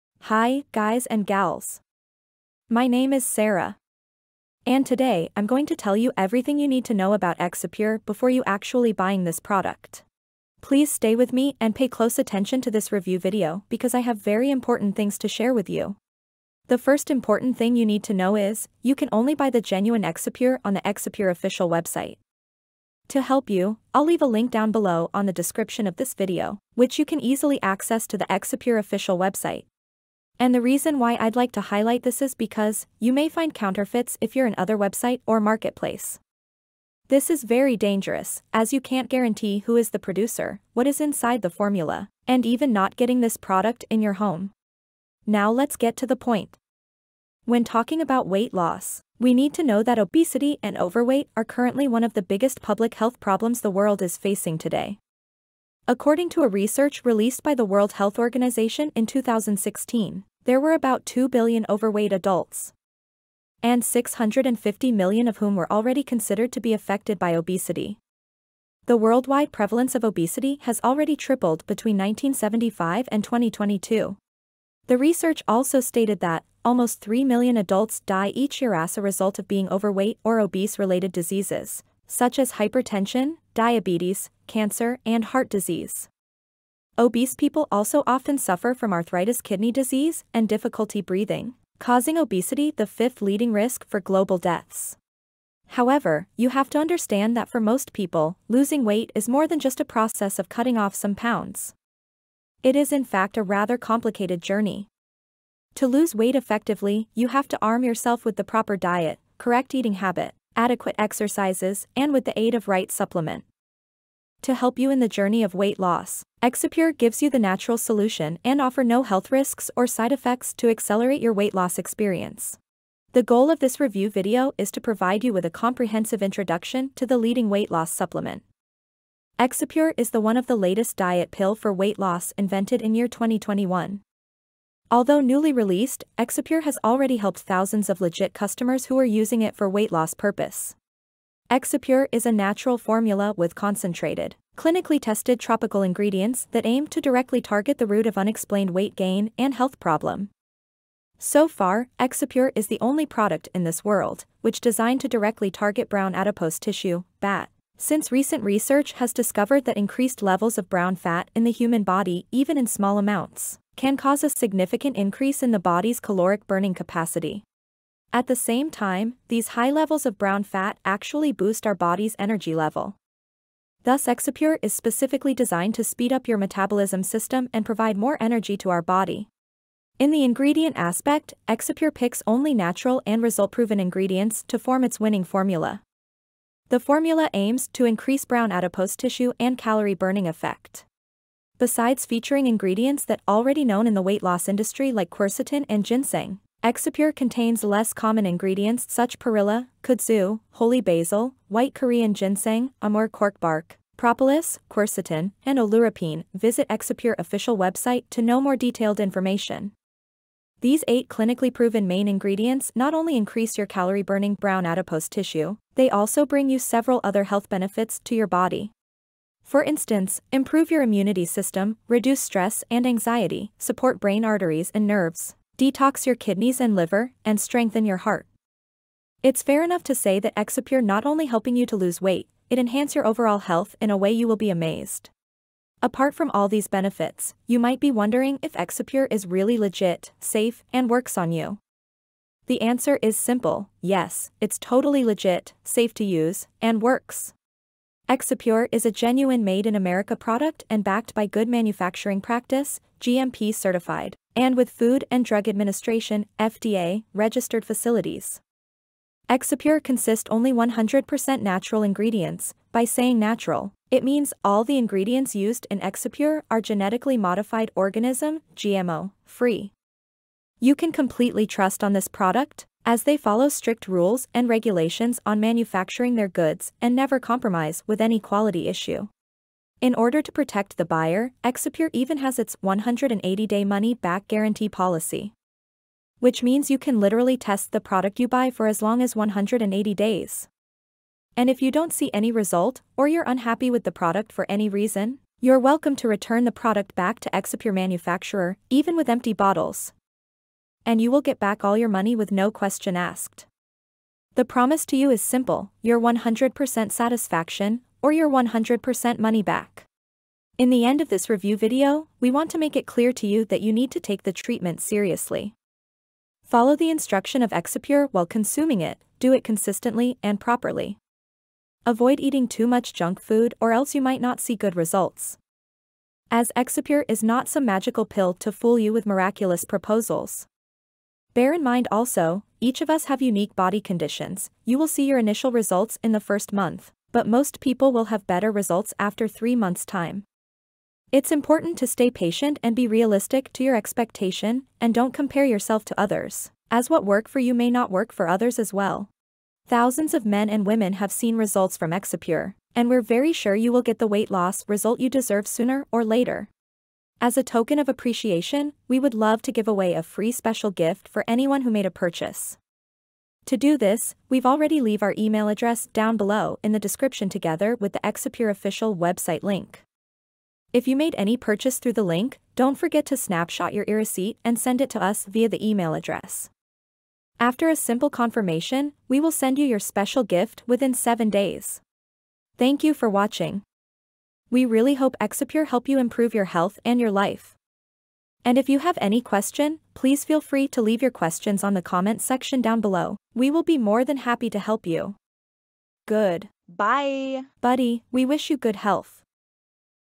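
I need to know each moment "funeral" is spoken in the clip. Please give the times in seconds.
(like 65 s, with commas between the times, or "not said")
not said.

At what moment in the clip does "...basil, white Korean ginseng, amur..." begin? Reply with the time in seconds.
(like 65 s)
200 s.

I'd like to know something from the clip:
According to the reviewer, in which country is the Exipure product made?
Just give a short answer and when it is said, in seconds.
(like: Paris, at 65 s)
America, at 249 s.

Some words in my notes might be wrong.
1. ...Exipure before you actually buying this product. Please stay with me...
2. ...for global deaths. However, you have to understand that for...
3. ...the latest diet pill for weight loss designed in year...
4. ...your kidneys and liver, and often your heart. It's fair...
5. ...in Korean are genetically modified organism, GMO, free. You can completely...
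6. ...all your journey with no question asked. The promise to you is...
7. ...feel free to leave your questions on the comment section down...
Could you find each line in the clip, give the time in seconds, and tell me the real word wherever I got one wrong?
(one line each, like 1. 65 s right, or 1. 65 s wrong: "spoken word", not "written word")
1. 7 s right
2. 93 s right
3. 130 s wrong: "invented", not "designed"
4. 226 s wrong: "strengthen", not "often"
5. 265 s wrong: "Exipure", not "Korean"
6. 301 s wrong: "money", not "journey"
7. 390 s right.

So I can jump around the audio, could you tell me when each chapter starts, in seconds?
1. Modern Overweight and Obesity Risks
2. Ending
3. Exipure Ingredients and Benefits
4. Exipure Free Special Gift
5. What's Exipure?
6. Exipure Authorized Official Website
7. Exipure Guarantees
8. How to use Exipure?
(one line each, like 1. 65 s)
1. 45 s
2. 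383 s
3. 191 s
4. 357 s
5. 123 s
6. 17 s
7. 248 s
8. 311 s.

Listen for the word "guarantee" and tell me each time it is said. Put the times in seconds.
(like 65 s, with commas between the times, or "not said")
39 s, 284 s.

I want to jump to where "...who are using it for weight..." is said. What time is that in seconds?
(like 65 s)
138 s.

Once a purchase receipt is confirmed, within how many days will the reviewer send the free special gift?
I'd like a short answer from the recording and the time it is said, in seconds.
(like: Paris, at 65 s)
7 days, at 380 s.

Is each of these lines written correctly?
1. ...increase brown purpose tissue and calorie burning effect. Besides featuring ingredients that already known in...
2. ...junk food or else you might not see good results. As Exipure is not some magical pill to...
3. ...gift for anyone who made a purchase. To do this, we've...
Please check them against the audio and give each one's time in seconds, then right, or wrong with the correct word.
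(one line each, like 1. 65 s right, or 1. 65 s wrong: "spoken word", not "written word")
1. 187 s wrong: "adipose", not "purpose"
2. 322 s right
3. 360 s right.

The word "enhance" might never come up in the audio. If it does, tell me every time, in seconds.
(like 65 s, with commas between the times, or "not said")
232 s.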